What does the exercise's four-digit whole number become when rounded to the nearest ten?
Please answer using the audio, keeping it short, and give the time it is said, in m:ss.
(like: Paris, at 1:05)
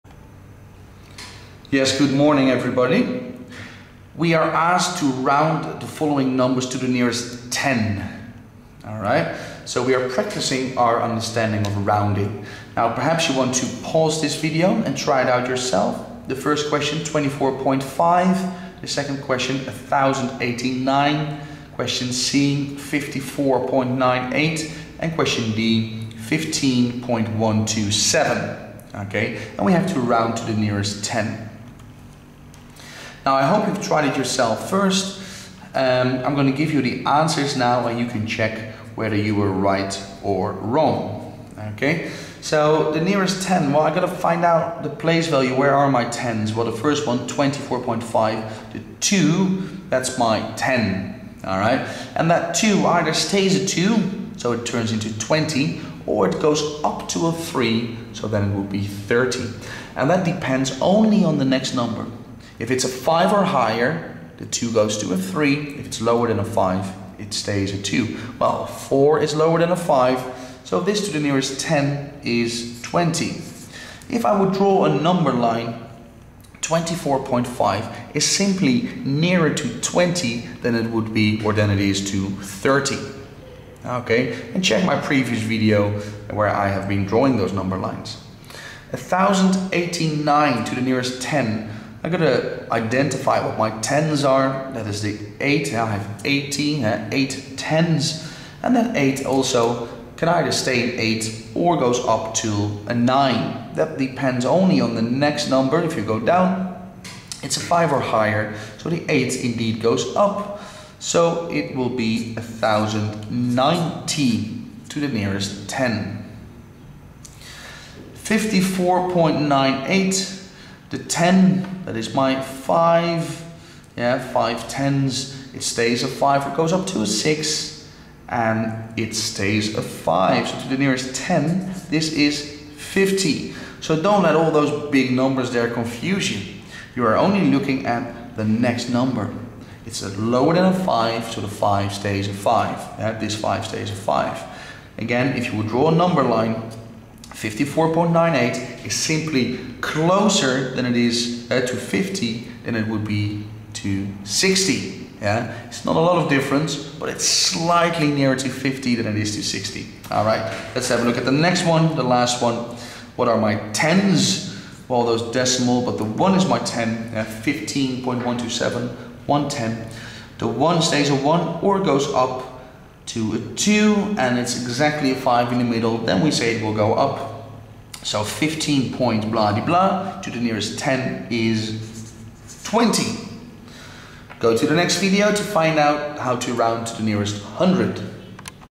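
1090, at 1:52.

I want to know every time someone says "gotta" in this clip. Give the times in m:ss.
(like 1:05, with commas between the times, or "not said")
0:43, 1:32.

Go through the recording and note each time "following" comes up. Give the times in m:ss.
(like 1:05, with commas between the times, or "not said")
0:05.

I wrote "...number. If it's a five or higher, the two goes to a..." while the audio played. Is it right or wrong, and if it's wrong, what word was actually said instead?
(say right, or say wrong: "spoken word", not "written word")
right.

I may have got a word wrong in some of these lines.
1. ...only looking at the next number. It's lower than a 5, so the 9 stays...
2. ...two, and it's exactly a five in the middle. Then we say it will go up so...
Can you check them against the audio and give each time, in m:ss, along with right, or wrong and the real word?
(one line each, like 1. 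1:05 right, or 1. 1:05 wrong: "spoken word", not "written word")
1. 2:17 wrong: "5", not "9"
2. 2:53 right.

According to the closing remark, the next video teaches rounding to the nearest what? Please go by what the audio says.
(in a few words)
100.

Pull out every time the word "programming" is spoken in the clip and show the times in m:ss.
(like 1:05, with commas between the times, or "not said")
not said.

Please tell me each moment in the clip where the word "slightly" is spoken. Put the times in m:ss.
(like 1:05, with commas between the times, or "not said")
2:37.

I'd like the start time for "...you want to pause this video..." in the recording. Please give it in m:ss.
0:13.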